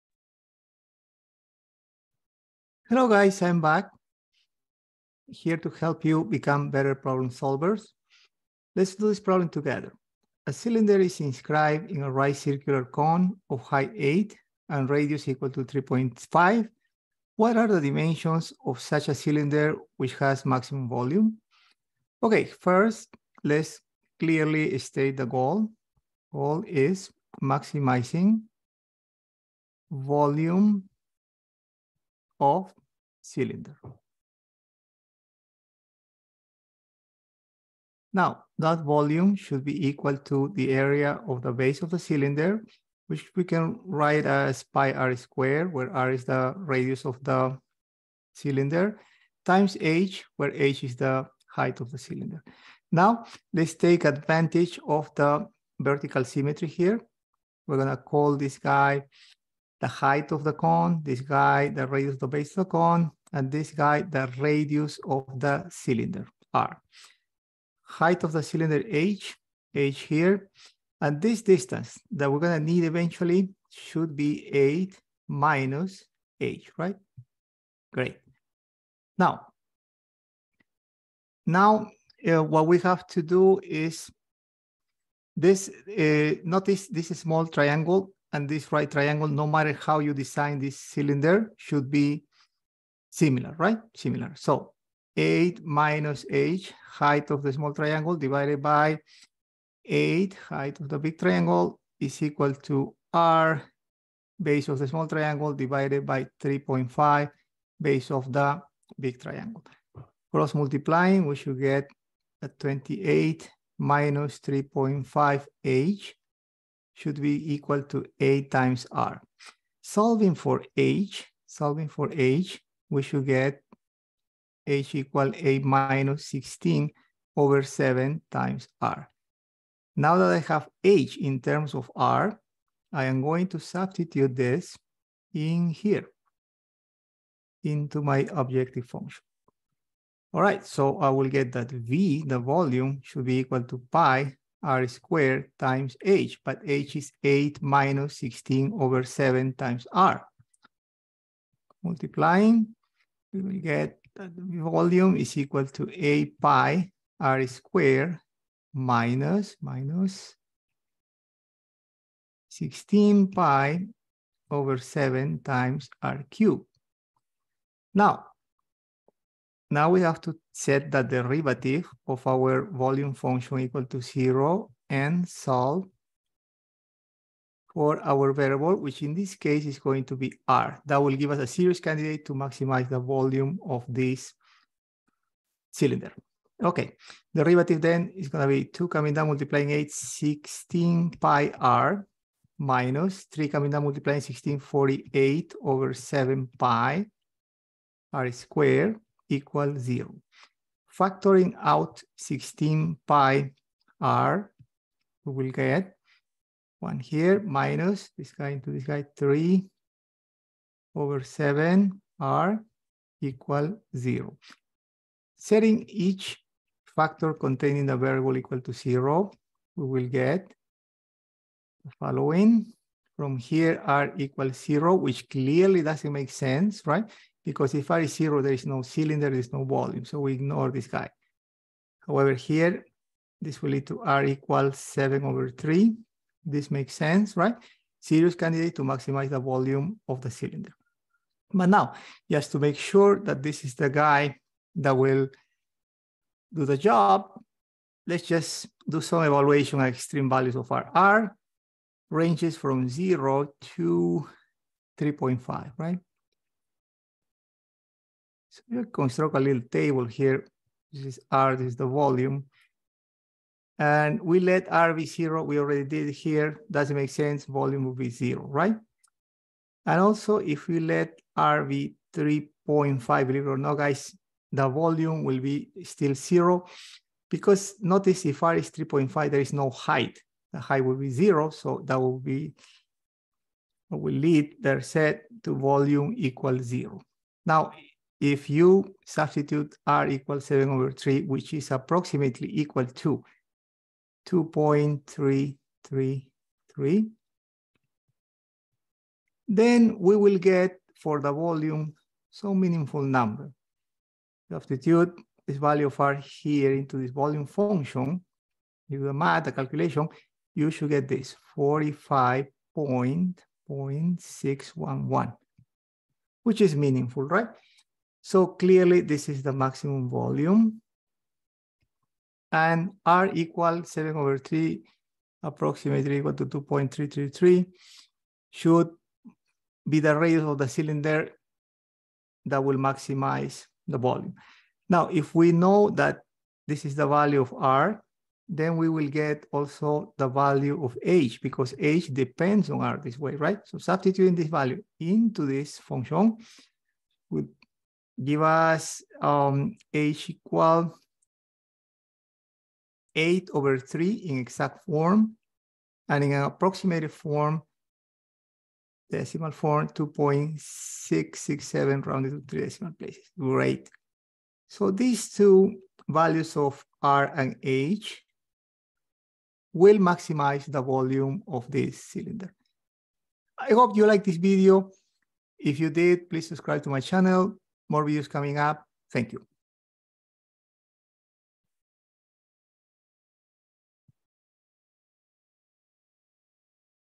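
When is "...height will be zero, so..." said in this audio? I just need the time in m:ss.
4:40.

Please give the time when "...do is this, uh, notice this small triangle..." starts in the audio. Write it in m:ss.
1:23.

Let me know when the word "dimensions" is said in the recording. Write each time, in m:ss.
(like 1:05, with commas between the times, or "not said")
0:17.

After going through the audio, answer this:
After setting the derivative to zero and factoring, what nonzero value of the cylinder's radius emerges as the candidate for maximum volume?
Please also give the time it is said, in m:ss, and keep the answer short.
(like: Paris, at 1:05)
7/3, at 3:54.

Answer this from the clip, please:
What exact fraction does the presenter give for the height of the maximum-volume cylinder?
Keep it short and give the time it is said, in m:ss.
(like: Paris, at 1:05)
8/3, at 5:53.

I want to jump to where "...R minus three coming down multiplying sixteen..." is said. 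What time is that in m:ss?
3:11.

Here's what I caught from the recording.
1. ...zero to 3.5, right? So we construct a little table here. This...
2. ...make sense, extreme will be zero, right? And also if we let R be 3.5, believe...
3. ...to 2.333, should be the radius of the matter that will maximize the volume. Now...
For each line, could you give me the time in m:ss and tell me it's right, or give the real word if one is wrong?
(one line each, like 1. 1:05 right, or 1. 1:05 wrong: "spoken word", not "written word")
1. 4:12 right
2. 4:26 wrong: "volume", not "extreme"
3. 5:26 wrong: "cylinder", not "matter".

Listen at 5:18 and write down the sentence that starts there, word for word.
So clearly this is the maximum volume.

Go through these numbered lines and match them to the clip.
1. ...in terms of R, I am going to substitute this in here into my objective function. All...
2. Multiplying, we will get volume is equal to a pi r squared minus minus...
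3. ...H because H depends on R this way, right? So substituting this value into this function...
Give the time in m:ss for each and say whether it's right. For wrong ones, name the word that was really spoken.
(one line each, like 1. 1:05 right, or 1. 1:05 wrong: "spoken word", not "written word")
1. 2:11 right
2. 2:31 right
3. 5:41 right.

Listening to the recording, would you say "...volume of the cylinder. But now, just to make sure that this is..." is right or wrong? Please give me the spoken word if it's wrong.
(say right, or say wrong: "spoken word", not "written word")
right.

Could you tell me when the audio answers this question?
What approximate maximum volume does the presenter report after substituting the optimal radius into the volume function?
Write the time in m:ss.
5:11.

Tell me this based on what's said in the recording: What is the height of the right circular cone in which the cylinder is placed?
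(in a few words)
8.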